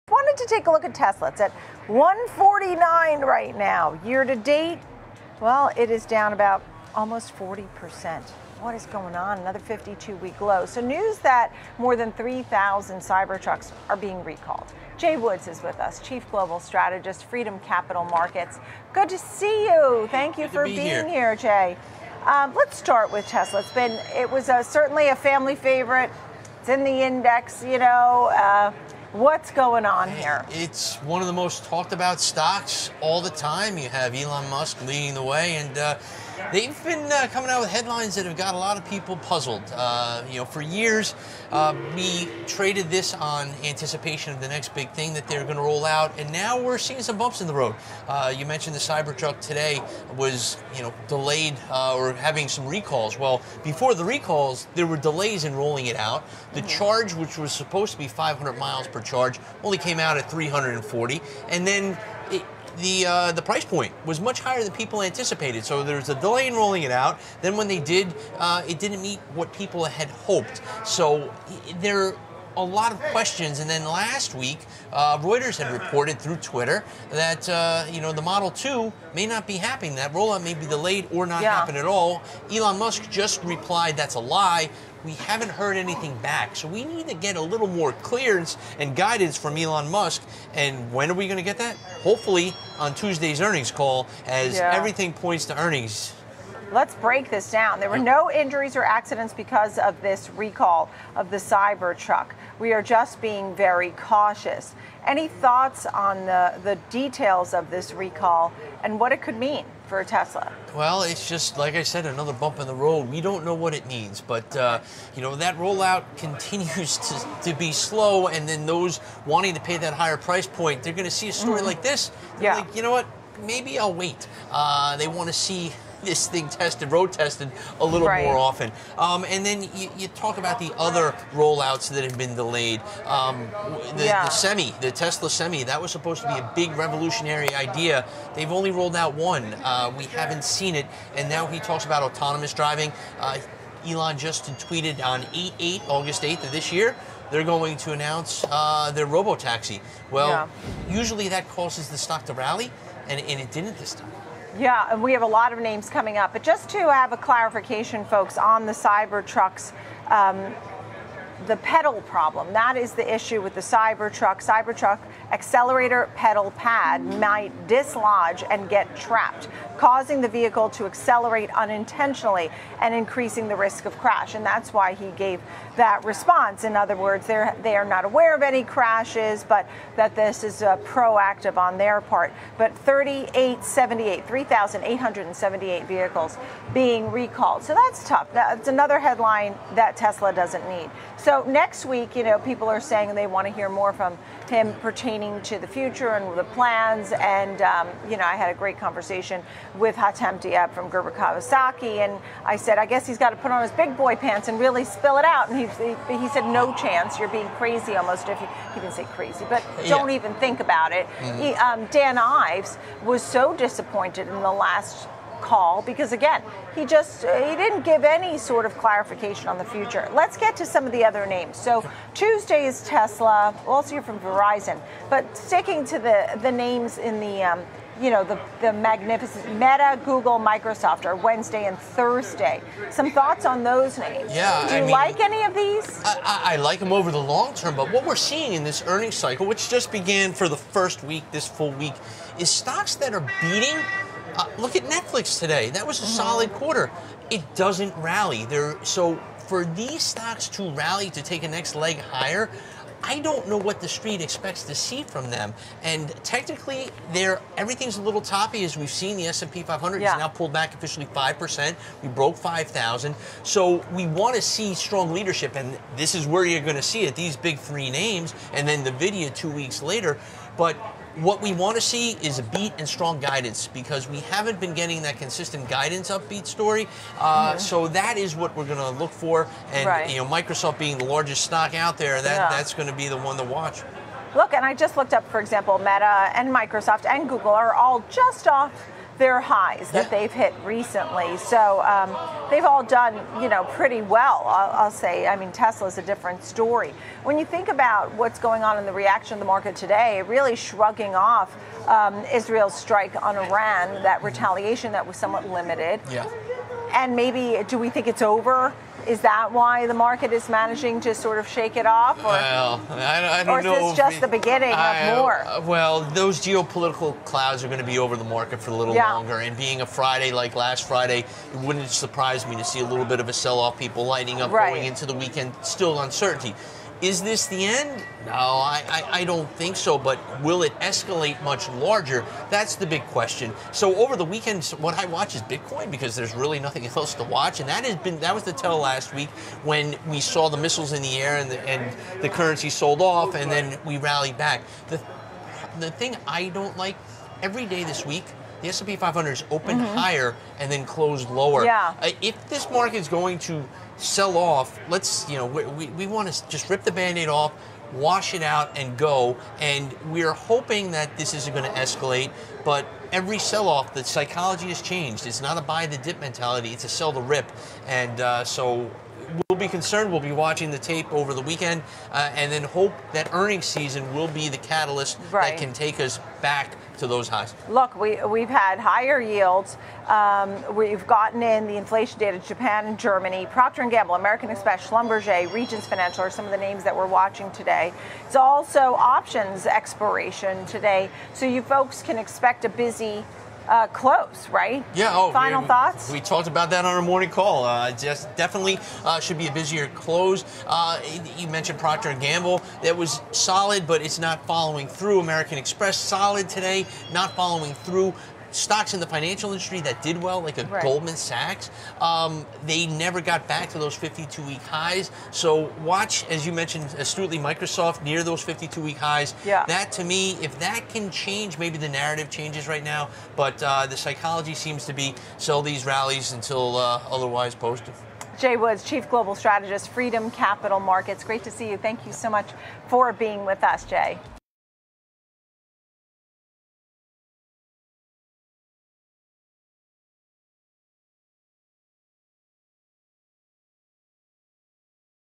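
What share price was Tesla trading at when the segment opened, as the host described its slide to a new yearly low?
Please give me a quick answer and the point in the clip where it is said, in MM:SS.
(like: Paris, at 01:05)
149, at 00:01.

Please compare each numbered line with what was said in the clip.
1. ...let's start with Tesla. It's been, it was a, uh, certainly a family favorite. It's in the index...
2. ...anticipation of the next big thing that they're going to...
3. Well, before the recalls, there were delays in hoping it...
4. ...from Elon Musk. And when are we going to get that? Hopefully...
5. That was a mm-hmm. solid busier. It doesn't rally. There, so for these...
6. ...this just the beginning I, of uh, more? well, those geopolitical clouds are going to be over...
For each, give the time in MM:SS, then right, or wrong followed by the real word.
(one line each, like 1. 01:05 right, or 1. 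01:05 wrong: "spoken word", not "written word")
1. 00:22 right
2. 00:43 right
3. 00:53 wrong: "rolling", not "hoping"
4. 01:29 right
5. 04:05 wrong: "quarter", not "busier"
6. 05:13 right.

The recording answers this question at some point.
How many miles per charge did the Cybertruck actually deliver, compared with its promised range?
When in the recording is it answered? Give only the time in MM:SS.
01:00.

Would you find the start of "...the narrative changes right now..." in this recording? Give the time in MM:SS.
07:01.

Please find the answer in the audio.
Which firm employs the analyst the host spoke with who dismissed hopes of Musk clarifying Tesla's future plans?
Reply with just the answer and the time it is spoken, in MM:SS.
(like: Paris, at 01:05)
Gerber Kawasaki, at 03:20.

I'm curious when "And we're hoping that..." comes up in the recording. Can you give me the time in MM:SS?
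05:59.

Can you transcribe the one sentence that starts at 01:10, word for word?
So there a lot of questions.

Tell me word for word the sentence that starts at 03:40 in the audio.
Let's get to some of the other names.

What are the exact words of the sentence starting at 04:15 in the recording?
And technically, they're, everything's a little toppy as we've seen.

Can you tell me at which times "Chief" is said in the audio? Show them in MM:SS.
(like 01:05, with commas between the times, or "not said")
00:16, 07:08.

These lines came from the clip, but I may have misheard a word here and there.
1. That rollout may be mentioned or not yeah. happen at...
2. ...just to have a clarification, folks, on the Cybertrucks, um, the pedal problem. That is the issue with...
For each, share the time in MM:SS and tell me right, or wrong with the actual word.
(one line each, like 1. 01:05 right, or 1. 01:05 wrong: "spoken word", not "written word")
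1. 01:19 wrong: "delayed", not "mentioned"
2. 02:36 right.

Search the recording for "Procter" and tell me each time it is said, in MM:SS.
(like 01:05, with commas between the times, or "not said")
06:23, 06:41.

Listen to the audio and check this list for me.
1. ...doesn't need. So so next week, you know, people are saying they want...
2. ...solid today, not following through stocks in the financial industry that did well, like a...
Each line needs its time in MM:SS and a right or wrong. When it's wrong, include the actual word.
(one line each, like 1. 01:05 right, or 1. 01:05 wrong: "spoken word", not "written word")
1. 03:10 right
2. 06:45 right.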